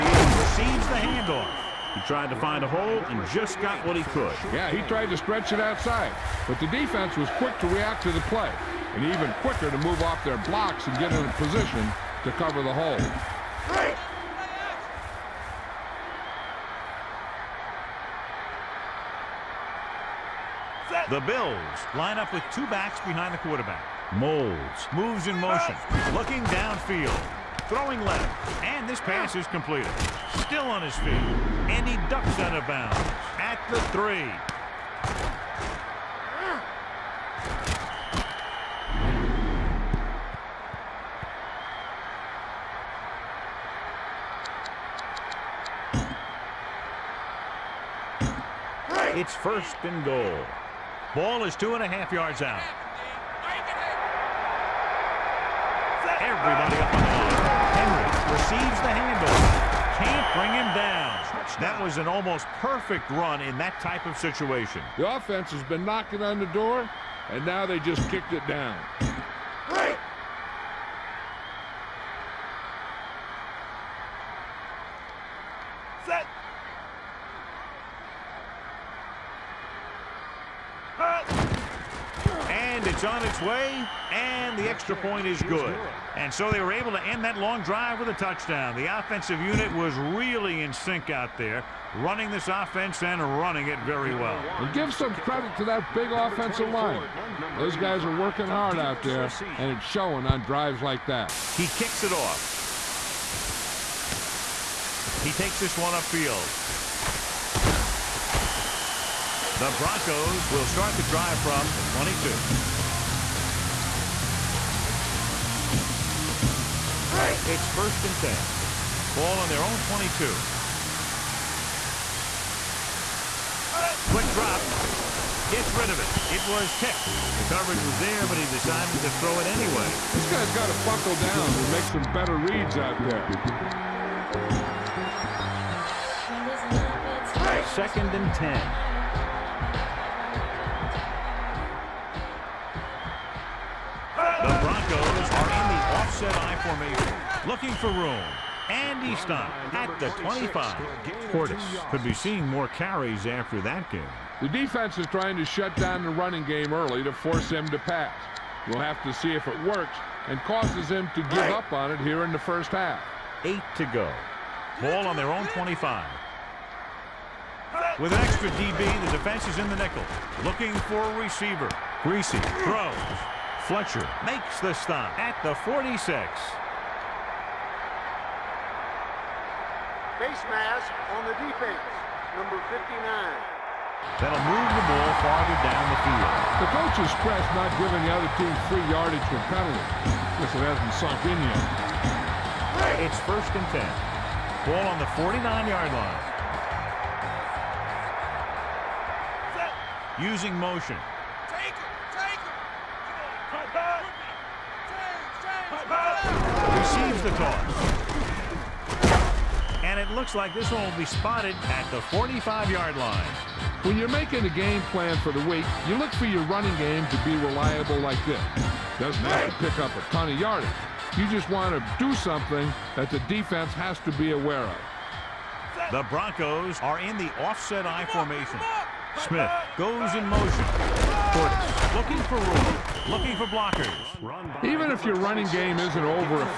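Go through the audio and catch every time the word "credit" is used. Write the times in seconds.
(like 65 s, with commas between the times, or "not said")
95 s.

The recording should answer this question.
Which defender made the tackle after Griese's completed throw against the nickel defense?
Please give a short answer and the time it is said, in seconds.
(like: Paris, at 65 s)
Fletcher, at 173 s.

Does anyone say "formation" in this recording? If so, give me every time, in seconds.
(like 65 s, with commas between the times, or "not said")
146 s, 228 s.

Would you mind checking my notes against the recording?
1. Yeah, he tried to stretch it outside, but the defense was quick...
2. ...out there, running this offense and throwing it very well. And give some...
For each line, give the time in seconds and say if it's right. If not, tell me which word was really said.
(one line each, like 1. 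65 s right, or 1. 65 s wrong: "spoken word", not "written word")
1. 4 s right
2. 91 s wrong: "running", not "throwing".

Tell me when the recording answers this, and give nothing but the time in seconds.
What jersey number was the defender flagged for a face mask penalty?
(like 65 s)
182 s.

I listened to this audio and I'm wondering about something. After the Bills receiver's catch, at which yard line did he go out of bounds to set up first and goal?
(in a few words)
3.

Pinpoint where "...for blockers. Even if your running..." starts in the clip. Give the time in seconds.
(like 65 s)
233 s.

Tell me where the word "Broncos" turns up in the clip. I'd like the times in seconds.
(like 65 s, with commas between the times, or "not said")
109 s, 226 s.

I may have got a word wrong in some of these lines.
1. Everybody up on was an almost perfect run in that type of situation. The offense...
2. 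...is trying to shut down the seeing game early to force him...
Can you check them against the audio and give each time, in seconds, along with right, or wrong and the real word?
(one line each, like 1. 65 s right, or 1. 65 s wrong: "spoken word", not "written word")
1. 56 s right
2. 154 s wrong: "running", not "seeing".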